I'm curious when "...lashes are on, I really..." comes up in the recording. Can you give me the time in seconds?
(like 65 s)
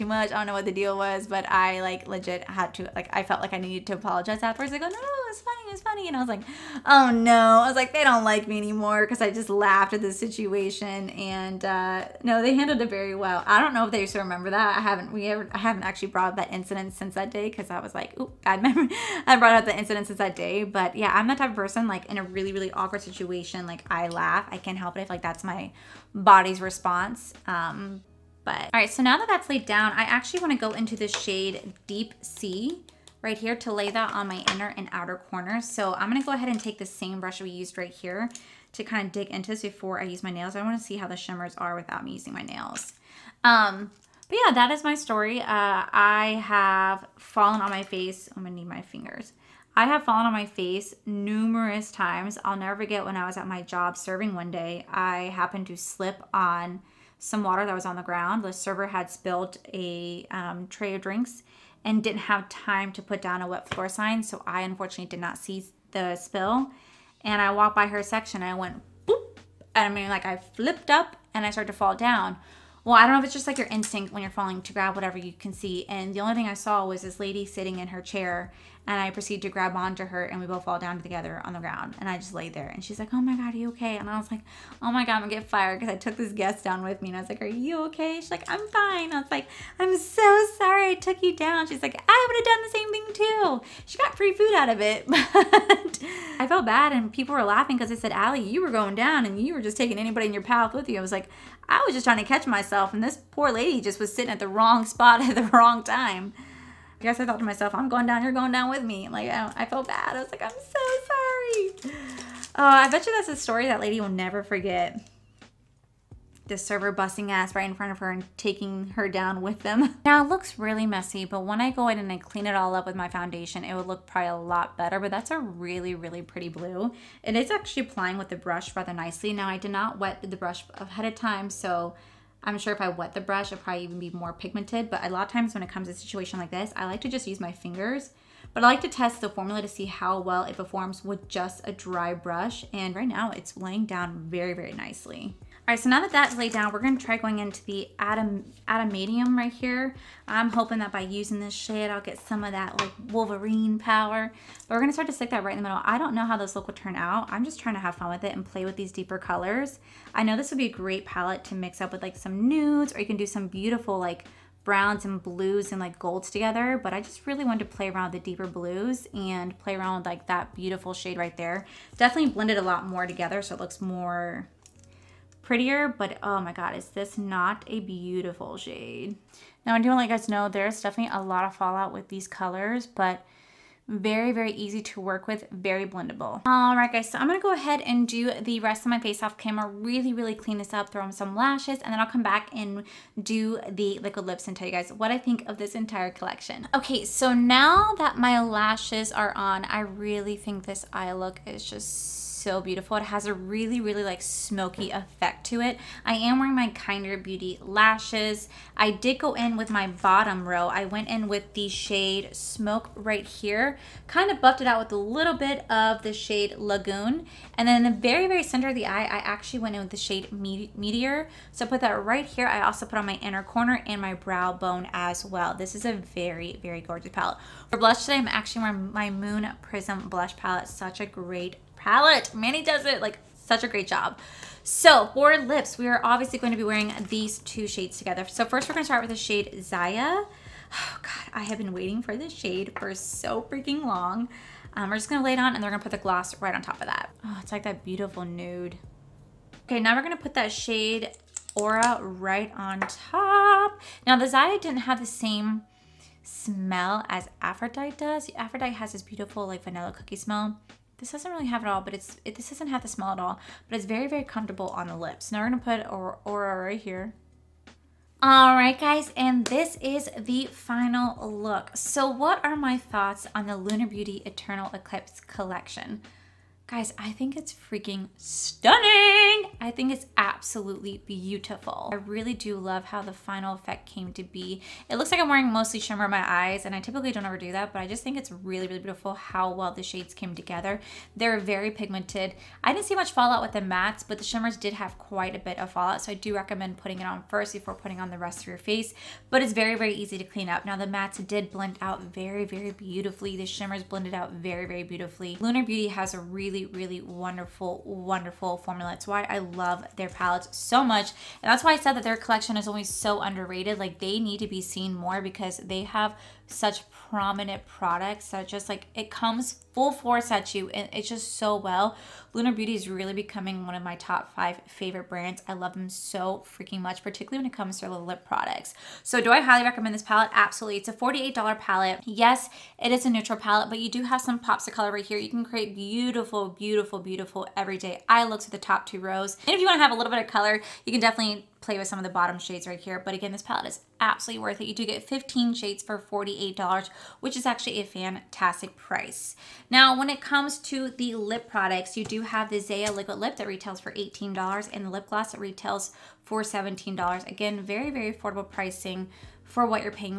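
198 s.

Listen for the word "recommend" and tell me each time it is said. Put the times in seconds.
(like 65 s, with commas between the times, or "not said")
296 s, 329 s.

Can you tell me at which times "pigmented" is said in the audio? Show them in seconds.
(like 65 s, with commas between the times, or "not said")
134 s, 291 s.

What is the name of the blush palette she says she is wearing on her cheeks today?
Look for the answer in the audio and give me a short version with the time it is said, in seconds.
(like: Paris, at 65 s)
Moon Prism, at 229 s.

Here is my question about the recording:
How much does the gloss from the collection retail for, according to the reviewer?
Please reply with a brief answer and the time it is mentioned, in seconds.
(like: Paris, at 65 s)
$17, at 356 s.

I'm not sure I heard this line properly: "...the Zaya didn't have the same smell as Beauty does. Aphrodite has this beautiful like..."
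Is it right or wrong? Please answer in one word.
wrong.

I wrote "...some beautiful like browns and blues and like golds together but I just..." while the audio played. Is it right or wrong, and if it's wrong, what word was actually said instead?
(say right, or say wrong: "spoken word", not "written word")
right.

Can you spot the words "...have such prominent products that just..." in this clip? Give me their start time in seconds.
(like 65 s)
315 s.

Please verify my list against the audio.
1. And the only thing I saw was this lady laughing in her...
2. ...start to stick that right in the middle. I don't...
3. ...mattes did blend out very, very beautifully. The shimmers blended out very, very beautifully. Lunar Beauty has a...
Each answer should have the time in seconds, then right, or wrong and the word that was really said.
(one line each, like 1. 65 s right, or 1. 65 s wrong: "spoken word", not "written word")
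1. 75 s wrong: "sitting", not "laughing"
2. 154 s right
3. 300 s right.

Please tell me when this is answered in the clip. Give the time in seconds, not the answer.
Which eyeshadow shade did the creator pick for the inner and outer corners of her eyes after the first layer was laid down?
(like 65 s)
31 s.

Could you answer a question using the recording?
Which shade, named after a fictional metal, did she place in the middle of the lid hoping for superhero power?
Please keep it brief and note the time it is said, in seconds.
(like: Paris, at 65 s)
Adamantium, at 148 s.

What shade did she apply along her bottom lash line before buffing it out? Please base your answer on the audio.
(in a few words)
Smoke.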